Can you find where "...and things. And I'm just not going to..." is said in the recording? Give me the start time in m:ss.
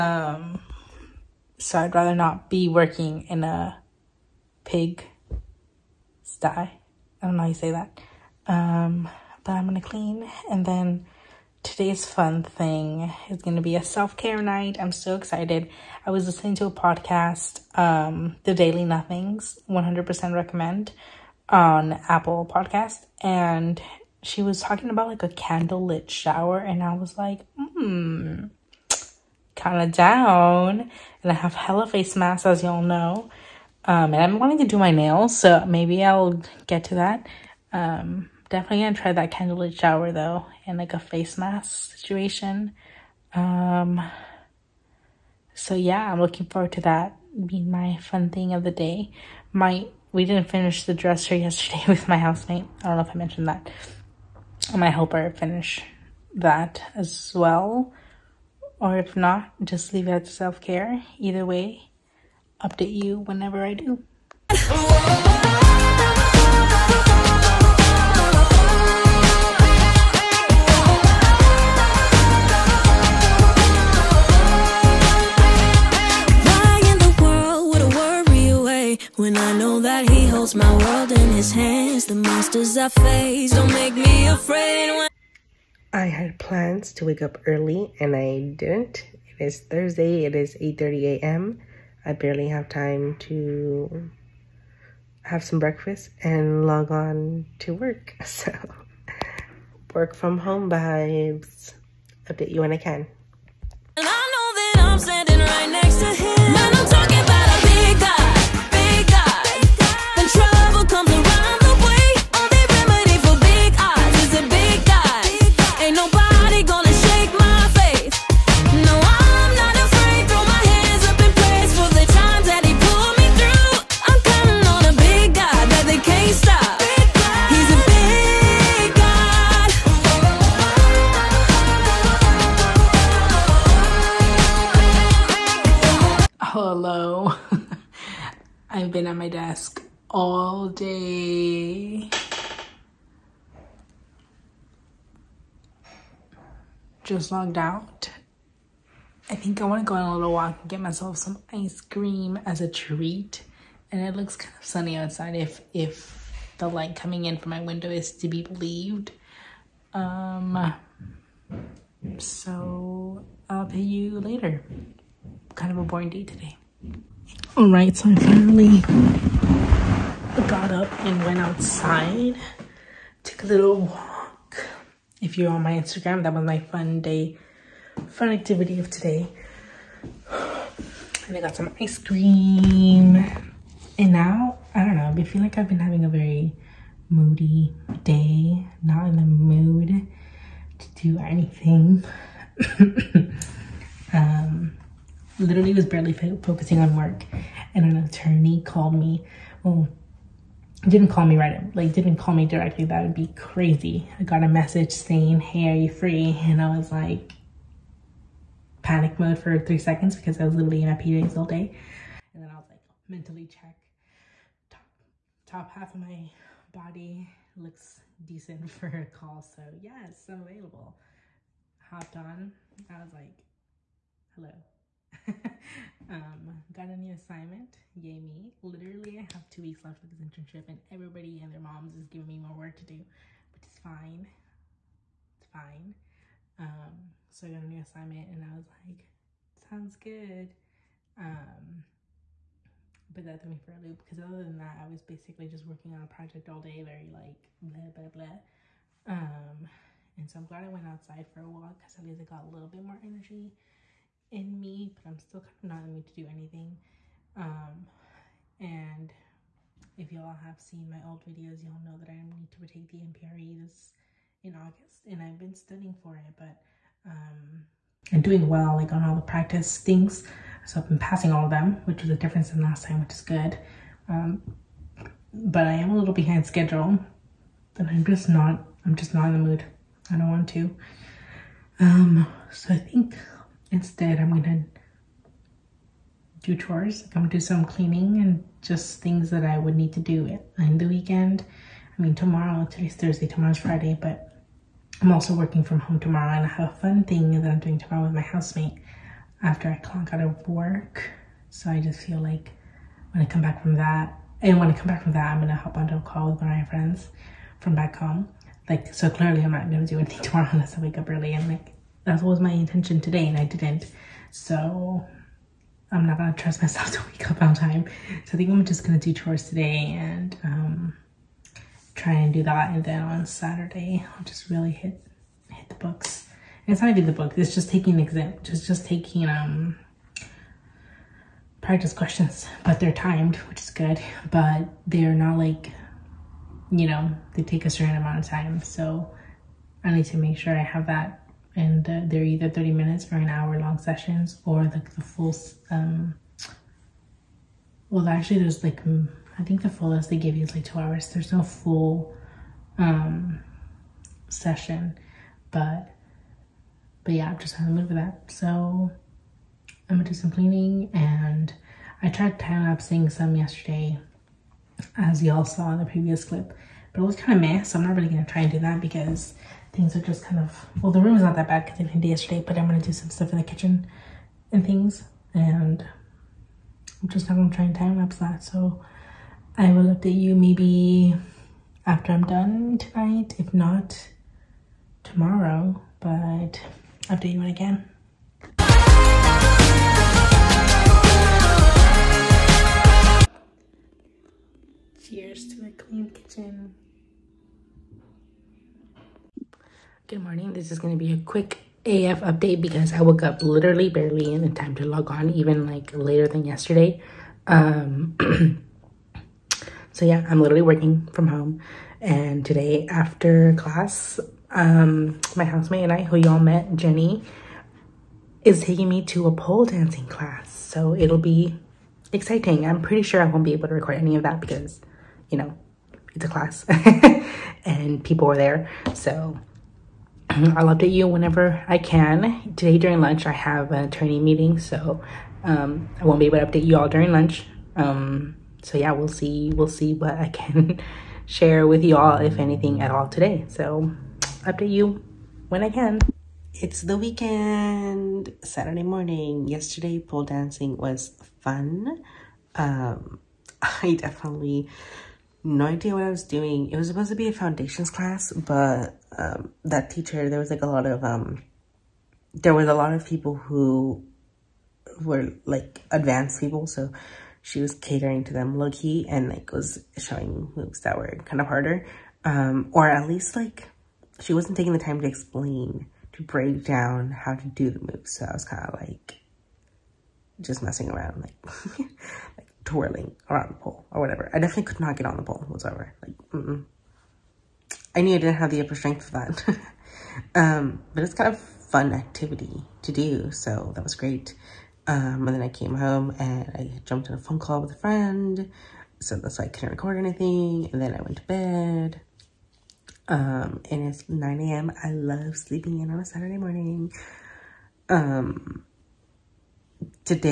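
6:14.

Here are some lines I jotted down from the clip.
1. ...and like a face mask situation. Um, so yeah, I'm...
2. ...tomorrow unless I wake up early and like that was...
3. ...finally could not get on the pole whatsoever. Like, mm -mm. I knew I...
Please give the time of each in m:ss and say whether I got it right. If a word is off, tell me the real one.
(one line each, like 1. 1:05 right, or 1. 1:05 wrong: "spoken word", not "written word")
1. 0:40 right
2. 5:10 right
3. 8:04 wrong: "definitely", not "finally".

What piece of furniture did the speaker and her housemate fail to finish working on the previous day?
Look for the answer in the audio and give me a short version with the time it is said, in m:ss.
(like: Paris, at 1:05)
Dresser, at 0:50.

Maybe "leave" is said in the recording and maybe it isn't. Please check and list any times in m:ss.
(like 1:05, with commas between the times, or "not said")
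0:59.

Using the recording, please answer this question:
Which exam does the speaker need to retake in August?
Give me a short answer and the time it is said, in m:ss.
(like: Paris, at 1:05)
MPRE, at 4:23.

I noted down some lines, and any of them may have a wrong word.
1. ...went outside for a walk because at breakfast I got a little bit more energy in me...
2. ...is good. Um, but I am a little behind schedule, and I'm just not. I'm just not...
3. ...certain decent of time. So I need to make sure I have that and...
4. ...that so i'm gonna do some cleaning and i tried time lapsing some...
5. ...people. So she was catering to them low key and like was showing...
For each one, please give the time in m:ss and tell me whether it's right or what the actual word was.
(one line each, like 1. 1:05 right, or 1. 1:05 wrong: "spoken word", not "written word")
1. 4:10 wrong: "least", not "breakfast"
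2. 4:33 right
3. 5:37 wrong: "amount", not "decent"
4. 5:57 right
5. 7:46 right.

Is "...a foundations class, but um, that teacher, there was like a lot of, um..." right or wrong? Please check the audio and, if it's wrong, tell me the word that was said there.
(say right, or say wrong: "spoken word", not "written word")
right.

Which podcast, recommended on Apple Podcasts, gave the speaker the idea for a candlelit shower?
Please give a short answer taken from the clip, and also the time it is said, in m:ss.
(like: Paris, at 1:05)
The Daily Nothings, at 0:18.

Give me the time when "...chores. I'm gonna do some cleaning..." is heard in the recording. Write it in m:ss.
4:46.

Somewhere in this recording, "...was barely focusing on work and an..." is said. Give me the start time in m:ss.
3:15.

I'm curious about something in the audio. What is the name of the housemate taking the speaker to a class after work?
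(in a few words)
Jenny.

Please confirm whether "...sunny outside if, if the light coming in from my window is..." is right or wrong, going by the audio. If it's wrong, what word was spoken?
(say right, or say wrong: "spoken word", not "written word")
right.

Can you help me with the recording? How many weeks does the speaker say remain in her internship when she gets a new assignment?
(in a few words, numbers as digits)
2.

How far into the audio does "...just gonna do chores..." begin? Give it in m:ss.
5:18.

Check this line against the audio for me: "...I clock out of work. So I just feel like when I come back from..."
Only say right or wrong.
right.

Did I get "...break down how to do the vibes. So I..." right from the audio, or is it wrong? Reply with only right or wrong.
wrong.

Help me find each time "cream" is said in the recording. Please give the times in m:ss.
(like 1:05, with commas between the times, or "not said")
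2:31, 3:01.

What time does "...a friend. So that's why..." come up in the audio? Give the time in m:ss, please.
8:17.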